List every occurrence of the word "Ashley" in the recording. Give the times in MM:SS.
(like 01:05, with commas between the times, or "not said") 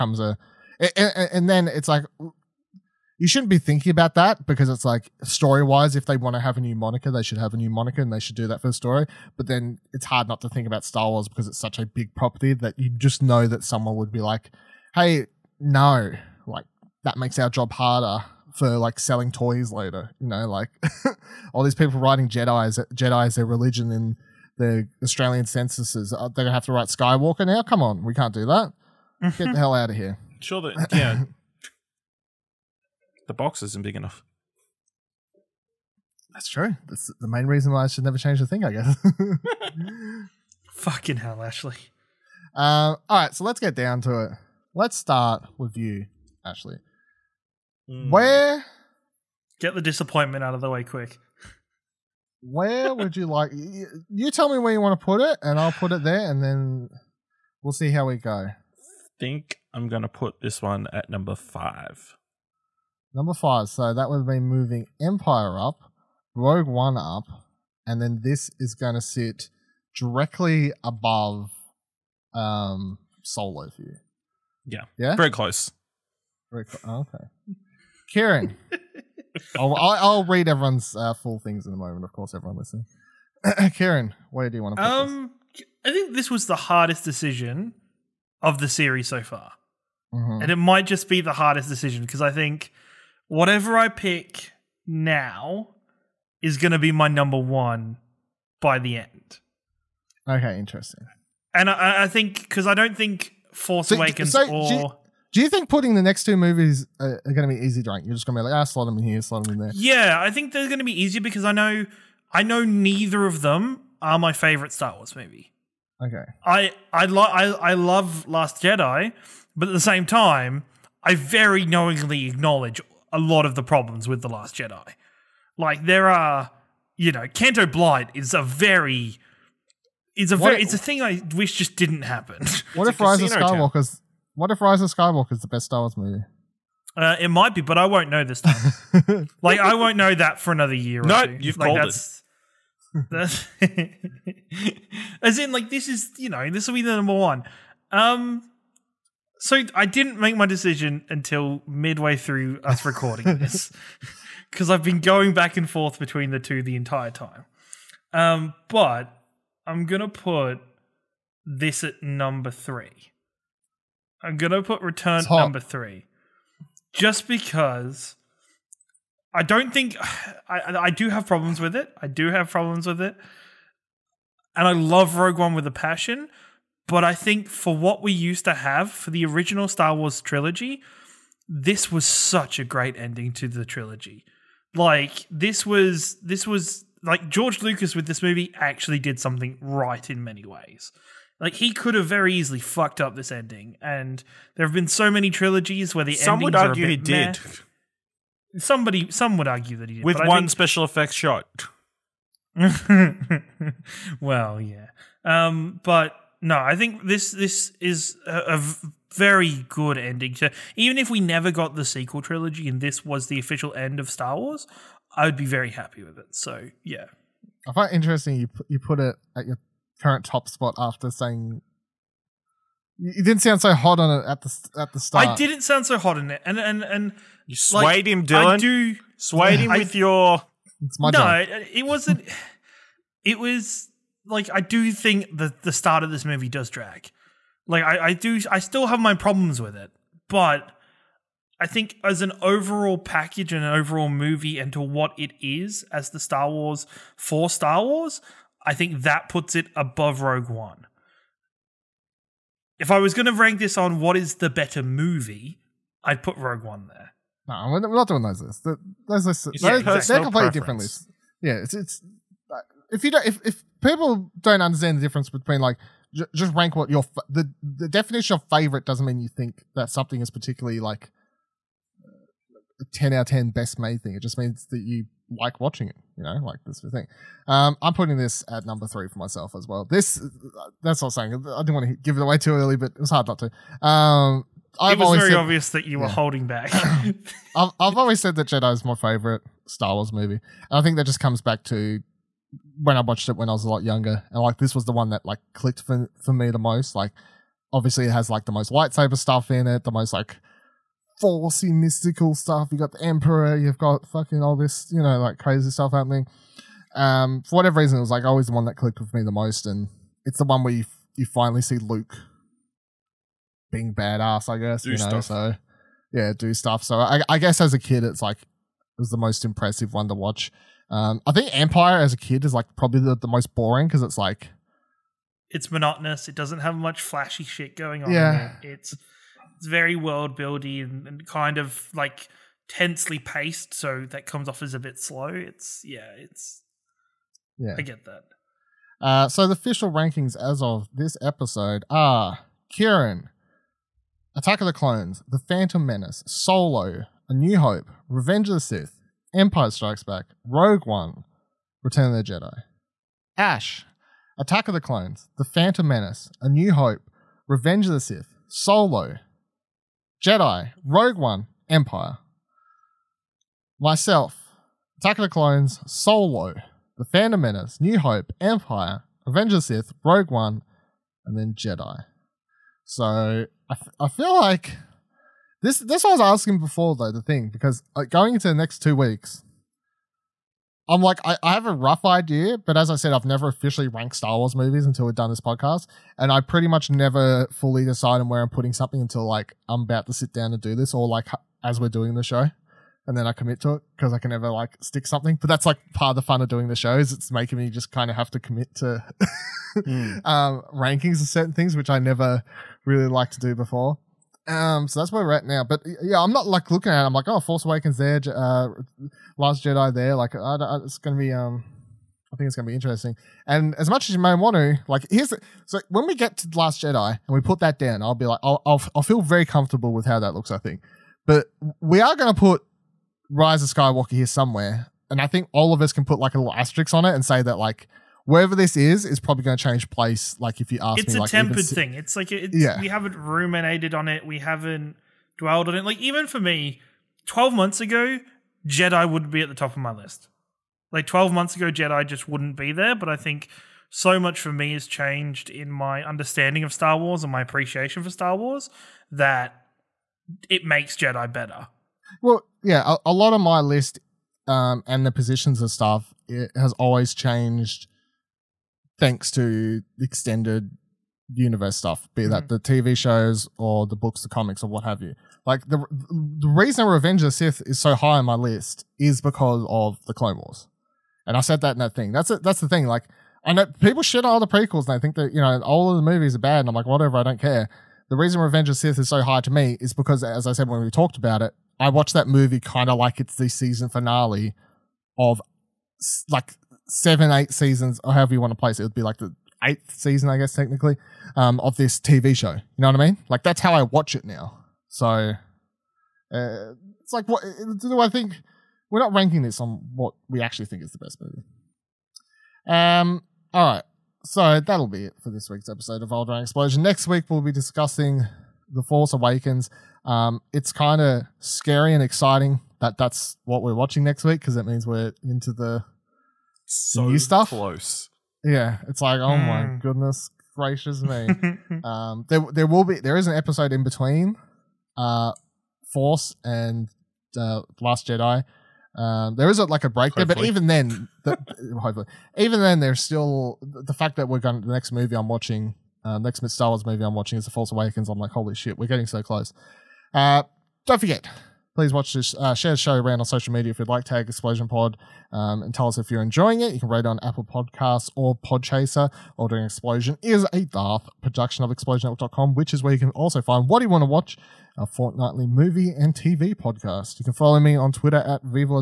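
00:41, 00:46.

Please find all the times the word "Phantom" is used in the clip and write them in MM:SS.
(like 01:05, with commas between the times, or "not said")
05:45, 05:55, 06:07.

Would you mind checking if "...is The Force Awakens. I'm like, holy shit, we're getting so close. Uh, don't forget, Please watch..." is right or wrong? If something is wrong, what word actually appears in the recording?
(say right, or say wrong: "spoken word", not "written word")
right.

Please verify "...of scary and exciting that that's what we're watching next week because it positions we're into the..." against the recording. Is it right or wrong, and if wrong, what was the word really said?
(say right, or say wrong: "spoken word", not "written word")
wrong: "means", not "positions".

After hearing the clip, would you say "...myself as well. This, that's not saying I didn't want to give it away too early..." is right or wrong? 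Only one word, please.
right.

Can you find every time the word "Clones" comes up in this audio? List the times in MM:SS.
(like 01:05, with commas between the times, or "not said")
05:44, 05:54, 06:05, 07:50.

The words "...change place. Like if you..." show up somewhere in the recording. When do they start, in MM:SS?
07:09.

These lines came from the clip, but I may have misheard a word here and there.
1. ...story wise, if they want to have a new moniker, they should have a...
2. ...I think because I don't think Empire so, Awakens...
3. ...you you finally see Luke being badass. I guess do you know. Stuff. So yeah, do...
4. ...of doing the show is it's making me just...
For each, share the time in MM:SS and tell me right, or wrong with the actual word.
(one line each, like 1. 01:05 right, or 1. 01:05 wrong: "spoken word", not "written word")
1. 00:05 right
2. 01:42 wrong: "Force", not "Empire"
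3. 05:10 right
4. 06:36 right.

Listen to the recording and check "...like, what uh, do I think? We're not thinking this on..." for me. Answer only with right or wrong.
wrong.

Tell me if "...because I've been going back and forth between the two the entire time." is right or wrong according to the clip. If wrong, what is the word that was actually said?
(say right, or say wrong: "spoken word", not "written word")
right.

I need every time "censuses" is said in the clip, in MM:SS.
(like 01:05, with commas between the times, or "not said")
00:25.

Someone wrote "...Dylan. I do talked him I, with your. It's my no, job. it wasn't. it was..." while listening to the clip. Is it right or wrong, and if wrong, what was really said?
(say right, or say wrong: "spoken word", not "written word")
wrong: "swayed", not "talked".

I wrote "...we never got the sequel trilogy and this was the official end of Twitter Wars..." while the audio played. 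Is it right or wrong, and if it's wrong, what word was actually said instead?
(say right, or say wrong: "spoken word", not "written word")
wrong: "Star", not "Twitter".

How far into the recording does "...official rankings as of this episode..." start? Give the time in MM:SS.
05:39.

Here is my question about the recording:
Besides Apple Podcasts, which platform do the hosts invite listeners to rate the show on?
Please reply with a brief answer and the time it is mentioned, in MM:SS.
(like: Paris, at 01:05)
Podchaser, at 09:08.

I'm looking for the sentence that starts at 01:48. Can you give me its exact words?
You're just going to be like, ah, slot them in here, slot them in there.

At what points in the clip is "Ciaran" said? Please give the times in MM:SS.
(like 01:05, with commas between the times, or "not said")
01:18, 01:23, 05:42.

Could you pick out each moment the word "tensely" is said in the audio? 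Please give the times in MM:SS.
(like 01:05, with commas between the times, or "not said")
05:32.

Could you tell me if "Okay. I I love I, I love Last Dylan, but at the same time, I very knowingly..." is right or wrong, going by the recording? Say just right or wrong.
wrong.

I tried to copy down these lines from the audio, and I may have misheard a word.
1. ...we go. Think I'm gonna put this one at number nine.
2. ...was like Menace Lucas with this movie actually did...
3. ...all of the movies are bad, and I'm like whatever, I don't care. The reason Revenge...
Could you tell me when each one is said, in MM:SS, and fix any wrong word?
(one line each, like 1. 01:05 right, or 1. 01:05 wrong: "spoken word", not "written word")
1. 00:58 wrong: "five", not "nine"
2. 03:06 wrong: "George", not "Menace"
3. 07:55 right.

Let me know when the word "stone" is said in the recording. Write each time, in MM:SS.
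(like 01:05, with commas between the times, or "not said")
not said.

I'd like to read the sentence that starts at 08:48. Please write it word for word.
Um, there is a, like a break hopefully.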